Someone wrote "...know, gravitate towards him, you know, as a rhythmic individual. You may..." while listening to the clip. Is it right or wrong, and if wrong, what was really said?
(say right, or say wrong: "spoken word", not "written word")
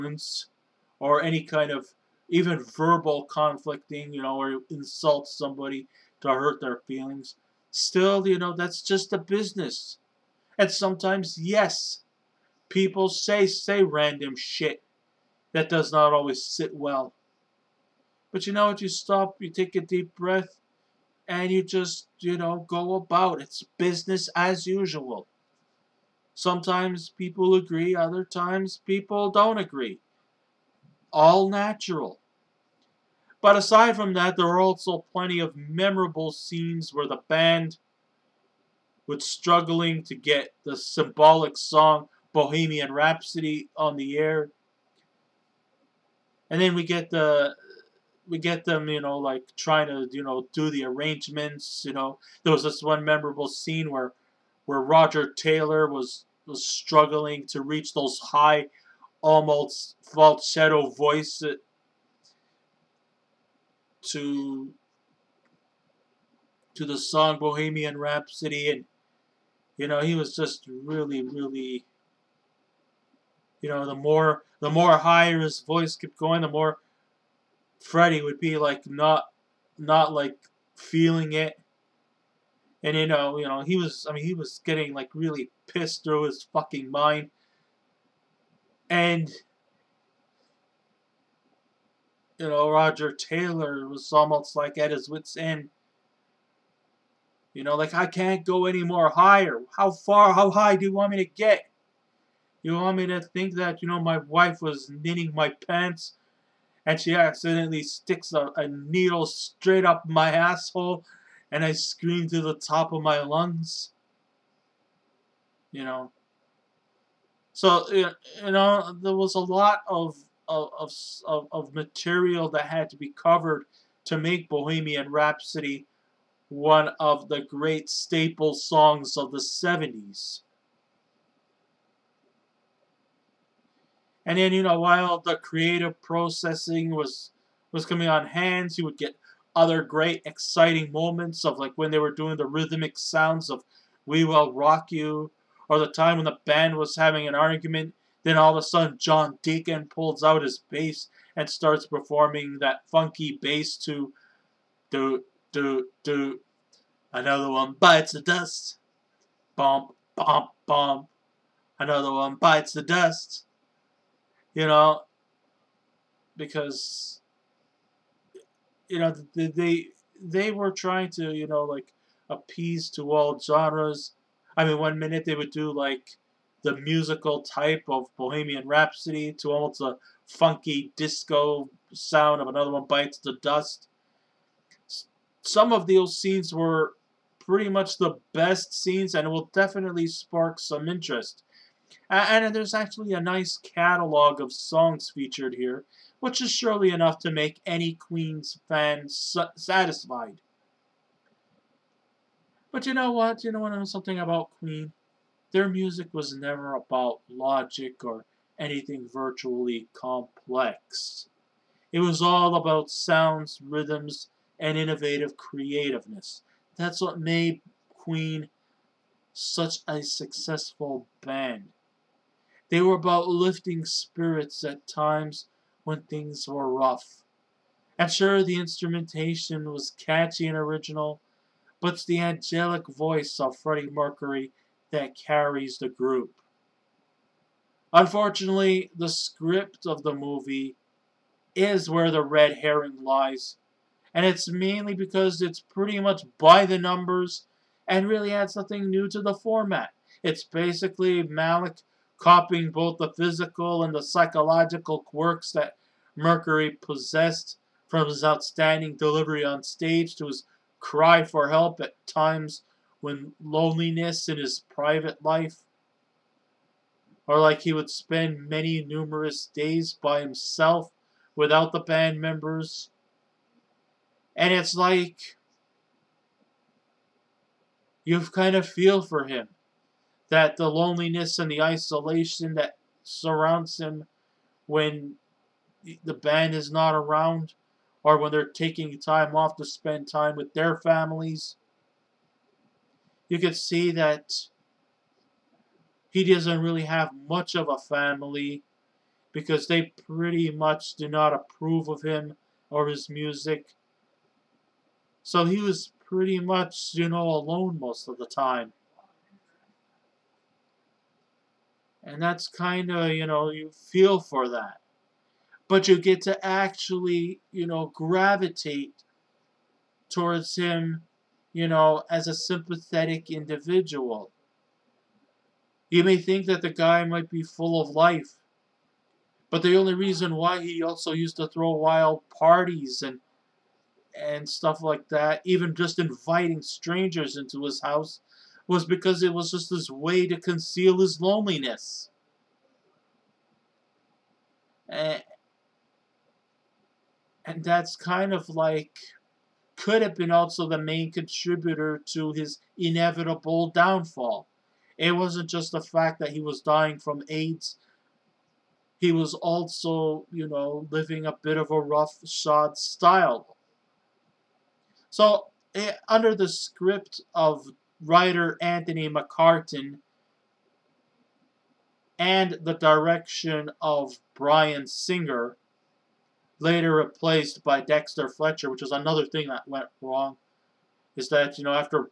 wrong: "sympathetic", not "rhythmic".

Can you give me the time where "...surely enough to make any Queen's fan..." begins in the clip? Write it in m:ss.
3:16.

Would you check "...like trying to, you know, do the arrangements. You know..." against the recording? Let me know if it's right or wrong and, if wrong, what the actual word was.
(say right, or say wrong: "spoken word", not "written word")
right.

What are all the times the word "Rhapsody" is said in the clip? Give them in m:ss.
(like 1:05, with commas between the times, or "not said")
0:42, 1:07, 2:05, 2:58.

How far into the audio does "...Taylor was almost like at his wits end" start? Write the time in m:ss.
1:33.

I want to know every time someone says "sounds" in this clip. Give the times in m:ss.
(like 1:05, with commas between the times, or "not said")
2:22, 3:01, 3:32.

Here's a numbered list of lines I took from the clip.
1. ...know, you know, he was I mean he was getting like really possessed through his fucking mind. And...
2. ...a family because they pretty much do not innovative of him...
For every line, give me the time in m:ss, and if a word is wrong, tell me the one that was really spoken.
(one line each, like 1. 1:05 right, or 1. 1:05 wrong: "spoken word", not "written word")
1. 1:23 wrong: "pissed", not "possessed"
2. 4:57 wrong: "approve", not "innovative".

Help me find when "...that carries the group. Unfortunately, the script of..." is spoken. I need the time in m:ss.
3:54.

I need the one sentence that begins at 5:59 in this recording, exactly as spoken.
He was also, you know, living a bit of a rough shod style.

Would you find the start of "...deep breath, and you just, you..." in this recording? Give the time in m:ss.
0:19.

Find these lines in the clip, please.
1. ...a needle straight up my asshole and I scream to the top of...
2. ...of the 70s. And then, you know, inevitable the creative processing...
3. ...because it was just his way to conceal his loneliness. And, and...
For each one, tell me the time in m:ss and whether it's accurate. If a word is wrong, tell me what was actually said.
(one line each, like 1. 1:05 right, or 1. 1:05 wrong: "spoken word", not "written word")
1. 1:48 right
2. 2:09 wrong: "while", not "inevitable"
3. 5:38 right.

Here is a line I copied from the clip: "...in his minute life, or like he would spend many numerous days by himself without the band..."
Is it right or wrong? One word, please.
wrong.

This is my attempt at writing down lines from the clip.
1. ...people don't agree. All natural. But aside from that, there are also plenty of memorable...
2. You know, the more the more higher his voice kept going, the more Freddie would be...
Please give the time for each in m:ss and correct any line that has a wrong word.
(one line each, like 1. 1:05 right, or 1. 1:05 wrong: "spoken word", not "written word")
1. 0:28 right
2. 1:13 right.